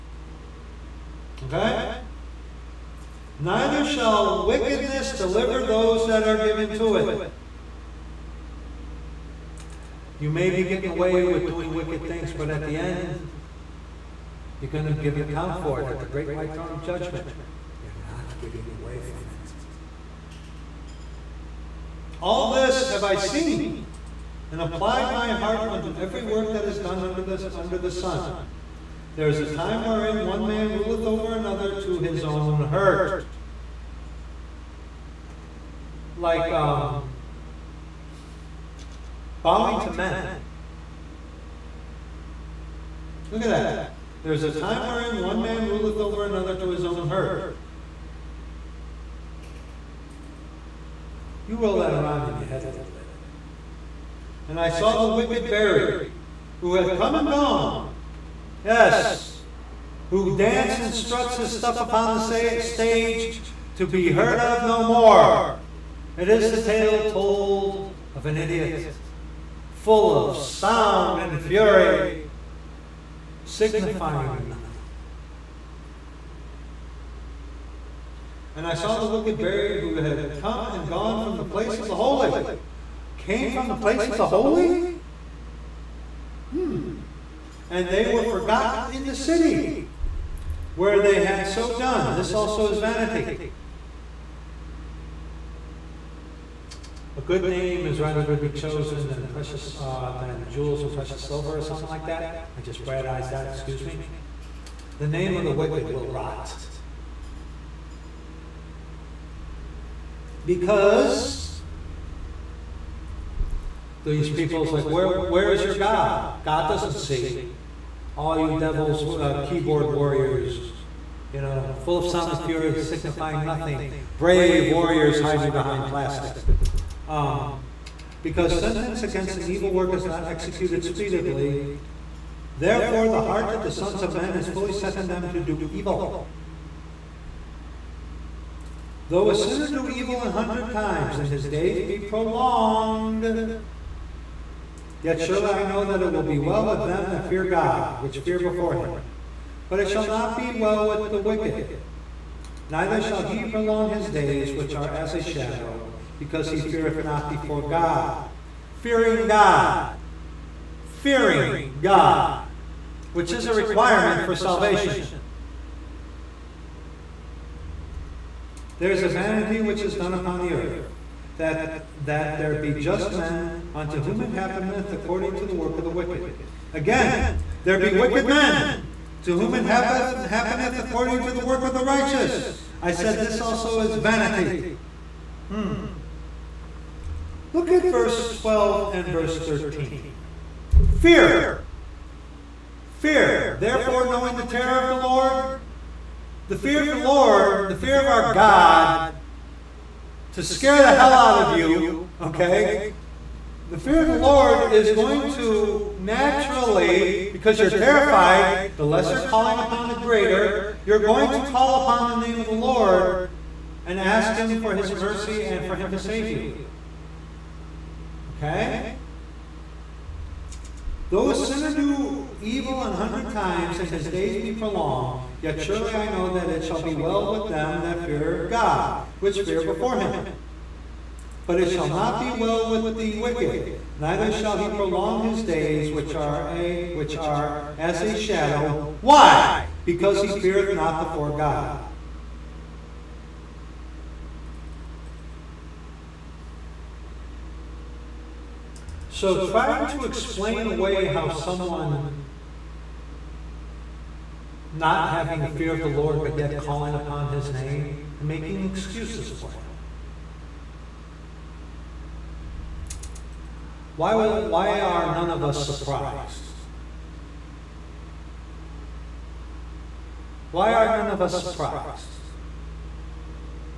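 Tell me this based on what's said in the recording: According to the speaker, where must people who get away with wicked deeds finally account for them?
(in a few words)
Great white throne of judgment.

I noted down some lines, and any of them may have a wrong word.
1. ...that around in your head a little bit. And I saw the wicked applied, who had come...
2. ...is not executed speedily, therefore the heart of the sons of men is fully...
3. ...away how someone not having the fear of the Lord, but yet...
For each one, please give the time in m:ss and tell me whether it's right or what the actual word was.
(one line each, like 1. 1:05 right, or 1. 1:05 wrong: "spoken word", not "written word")
1. 0:51 wrong: "buried", not "applied"
2. 2:09 right
3. 4:10 right.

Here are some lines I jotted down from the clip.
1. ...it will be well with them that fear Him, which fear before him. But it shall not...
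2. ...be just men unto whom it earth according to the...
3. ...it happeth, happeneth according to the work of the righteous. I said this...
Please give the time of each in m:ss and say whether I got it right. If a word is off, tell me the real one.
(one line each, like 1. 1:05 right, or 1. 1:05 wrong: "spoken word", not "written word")
1. 2:26 wrong: "God", not "Him"
2. 2:52 wrong: "happeneth", not "earth"
3. 2:59 right.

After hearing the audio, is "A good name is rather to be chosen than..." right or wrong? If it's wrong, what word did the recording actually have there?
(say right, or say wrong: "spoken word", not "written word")
right.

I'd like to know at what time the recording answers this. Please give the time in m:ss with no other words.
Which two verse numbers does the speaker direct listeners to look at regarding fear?
3:07.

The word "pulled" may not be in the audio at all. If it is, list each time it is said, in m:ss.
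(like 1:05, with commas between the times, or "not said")
not said.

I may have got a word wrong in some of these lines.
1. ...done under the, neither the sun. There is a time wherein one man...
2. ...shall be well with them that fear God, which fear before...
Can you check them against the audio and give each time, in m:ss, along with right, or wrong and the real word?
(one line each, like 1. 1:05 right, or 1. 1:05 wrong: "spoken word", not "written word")
1. 0:26 wrong: "under", not "neither"
2. 3:46 right.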